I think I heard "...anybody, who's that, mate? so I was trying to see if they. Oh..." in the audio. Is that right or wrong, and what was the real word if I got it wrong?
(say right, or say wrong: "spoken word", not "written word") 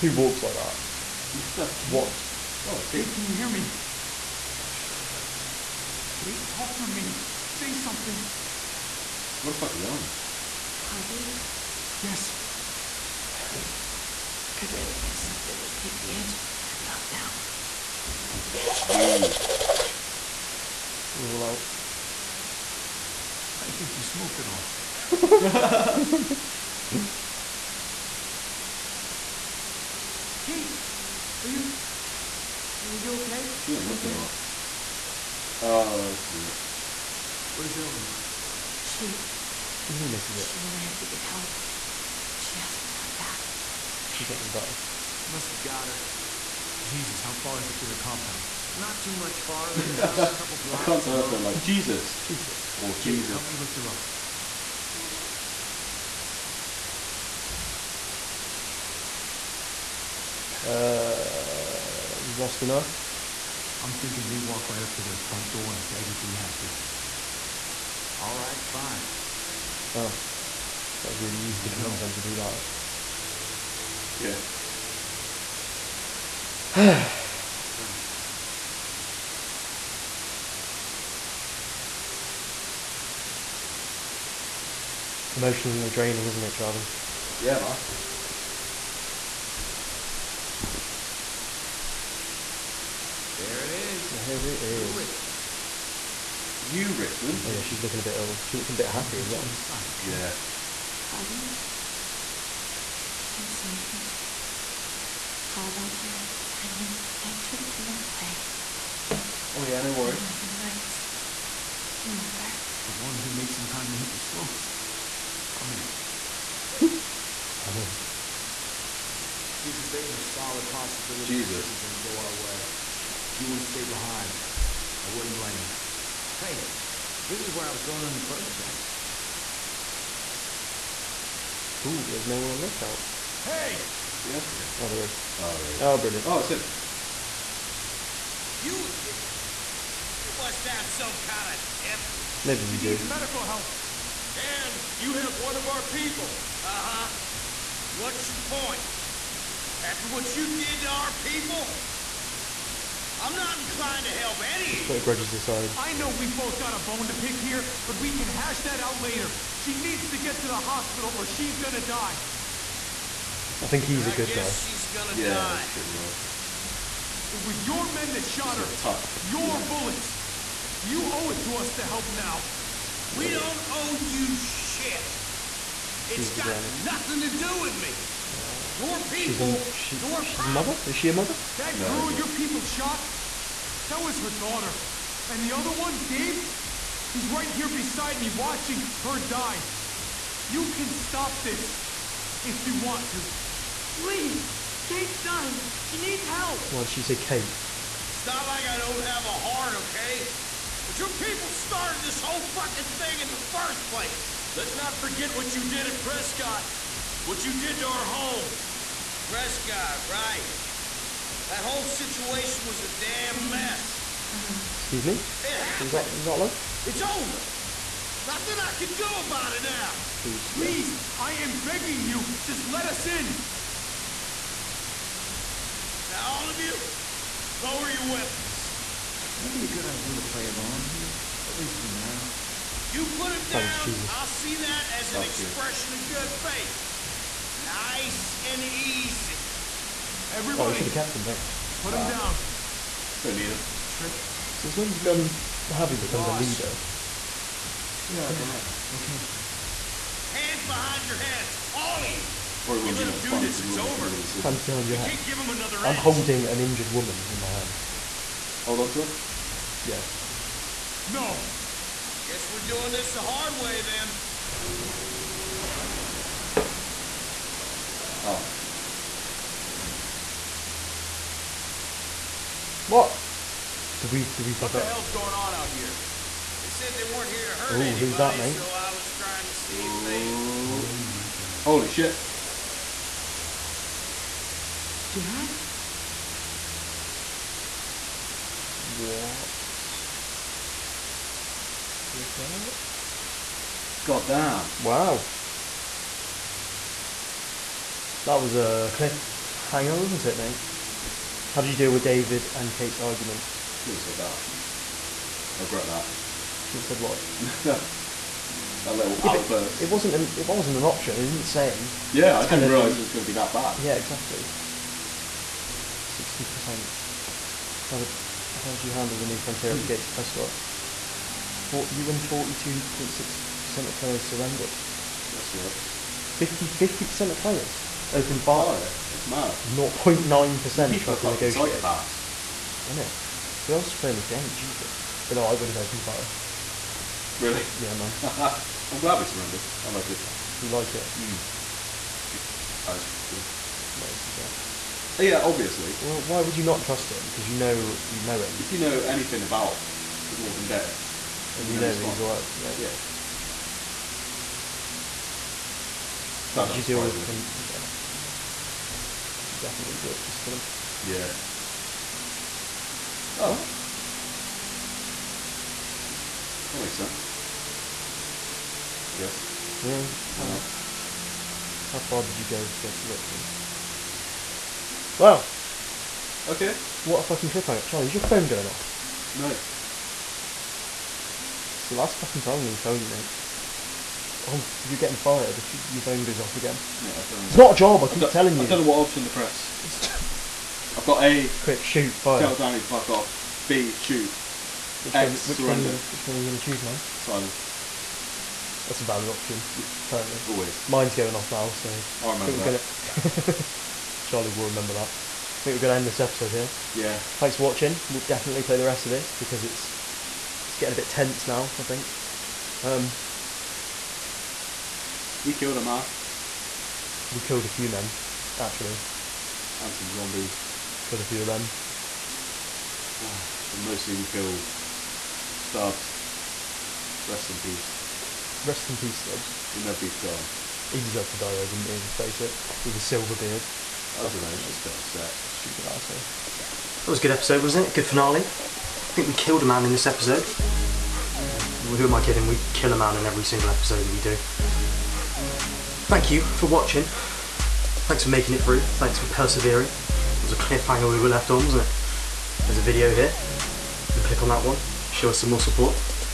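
right.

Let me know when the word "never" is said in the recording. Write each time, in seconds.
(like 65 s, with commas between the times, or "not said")
429 s.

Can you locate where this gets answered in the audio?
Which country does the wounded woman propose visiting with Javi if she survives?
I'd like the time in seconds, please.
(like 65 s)
107 s.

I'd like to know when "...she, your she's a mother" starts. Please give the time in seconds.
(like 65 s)
179 s.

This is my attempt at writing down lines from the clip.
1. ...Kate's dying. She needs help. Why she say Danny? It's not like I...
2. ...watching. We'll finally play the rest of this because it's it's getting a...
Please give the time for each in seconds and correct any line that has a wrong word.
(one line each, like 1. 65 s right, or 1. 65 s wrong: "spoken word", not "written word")
1. 194 s wrong: "Kate", not "Danny"
2. 407 s wrong: "definitely", not "finally".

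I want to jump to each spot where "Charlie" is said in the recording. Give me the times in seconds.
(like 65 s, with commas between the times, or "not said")
86 s, 377 s, 404 s.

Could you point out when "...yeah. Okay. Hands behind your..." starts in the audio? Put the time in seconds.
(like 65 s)
248 s.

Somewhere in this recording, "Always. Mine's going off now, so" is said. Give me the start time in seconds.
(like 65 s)
400 s.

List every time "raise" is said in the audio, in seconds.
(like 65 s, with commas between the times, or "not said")
not said.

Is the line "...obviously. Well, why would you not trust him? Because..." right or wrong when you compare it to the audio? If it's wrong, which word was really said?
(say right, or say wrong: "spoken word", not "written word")
right.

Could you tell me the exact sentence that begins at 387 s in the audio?
It's what, not a job, I, I keep telling you.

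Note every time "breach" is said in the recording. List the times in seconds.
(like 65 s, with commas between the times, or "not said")
not said.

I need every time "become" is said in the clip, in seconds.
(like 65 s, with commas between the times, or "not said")
246 s.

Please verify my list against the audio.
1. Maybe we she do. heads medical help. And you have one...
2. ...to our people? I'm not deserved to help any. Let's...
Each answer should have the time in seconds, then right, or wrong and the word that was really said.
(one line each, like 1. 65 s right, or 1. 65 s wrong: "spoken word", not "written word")
1. 142 s wrong: "needs", not "heads"
2. 150 s wrong: "inclined", not "deserved".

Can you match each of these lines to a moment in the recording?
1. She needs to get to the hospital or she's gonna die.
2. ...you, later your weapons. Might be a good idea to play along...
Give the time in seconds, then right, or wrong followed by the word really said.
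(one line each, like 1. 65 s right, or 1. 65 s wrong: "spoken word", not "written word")
1. 159 s right
2. 226 s wrong: "lower", not "later".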